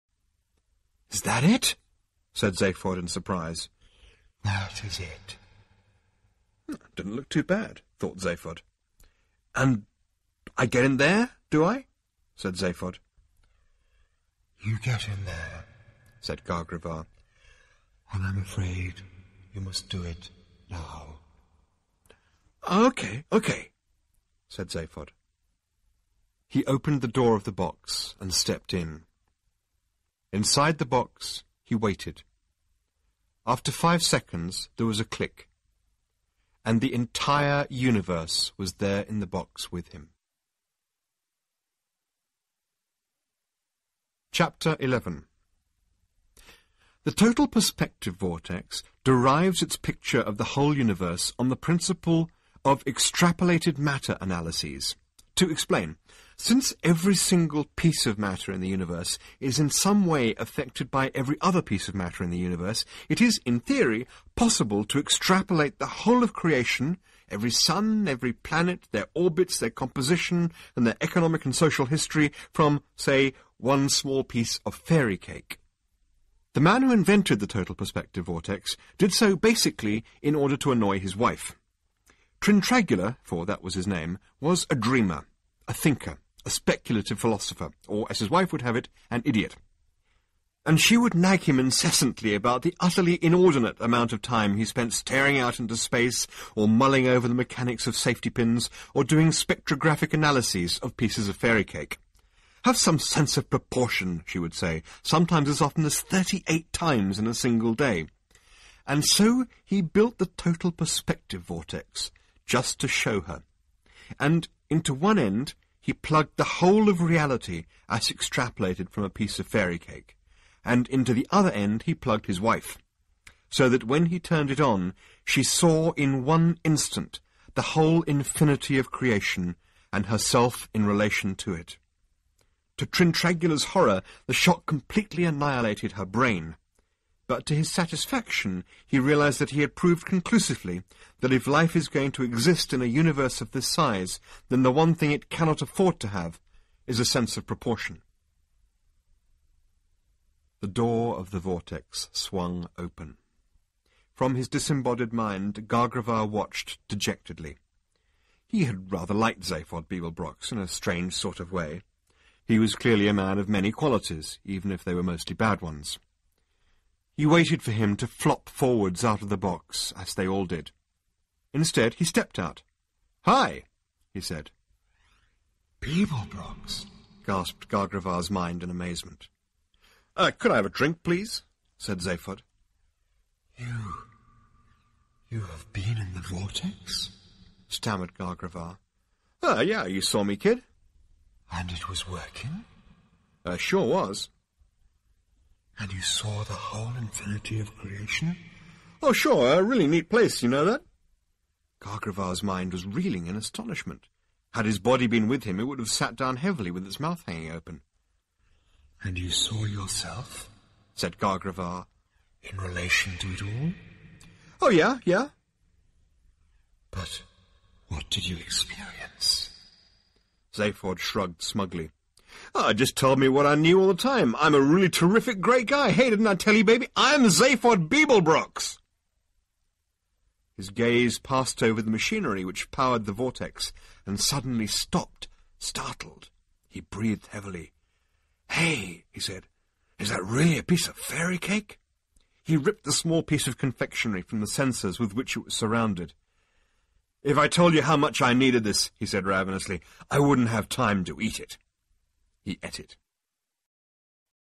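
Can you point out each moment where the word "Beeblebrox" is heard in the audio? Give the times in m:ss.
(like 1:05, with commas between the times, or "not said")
2:39, 3:47.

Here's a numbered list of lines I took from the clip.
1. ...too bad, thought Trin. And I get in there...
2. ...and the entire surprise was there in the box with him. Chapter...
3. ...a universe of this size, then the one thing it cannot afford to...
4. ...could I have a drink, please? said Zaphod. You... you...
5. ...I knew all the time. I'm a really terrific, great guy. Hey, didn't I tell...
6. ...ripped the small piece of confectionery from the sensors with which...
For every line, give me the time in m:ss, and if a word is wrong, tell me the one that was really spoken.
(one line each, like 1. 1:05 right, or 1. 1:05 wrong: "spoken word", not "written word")
1. 0:07 wrong: "Zaphod", not "Trin"
2. 0:36 wrong: "universe", not "surprise"
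3. 2:22 right
4. 3:00 right
5. 3:43 right
6. 4:02 right.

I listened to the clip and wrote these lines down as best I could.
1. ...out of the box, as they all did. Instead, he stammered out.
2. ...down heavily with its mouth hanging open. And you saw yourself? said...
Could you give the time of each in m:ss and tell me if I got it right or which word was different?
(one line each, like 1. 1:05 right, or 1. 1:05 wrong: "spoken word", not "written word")
1. 2:49 wrong: "stepped", not "stammered"
2. 3:26 right.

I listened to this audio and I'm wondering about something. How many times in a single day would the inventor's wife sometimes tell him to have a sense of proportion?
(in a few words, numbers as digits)
38.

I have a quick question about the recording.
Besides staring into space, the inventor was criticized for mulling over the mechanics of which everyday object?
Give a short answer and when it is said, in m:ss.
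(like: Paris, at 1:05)
safety pins, at 1:37.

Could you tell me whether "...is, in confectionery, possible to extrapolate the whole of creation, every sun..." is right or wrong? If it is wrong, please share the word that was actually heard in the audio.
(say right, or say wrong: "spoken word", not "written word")
wrong: "theory", not "confectionery".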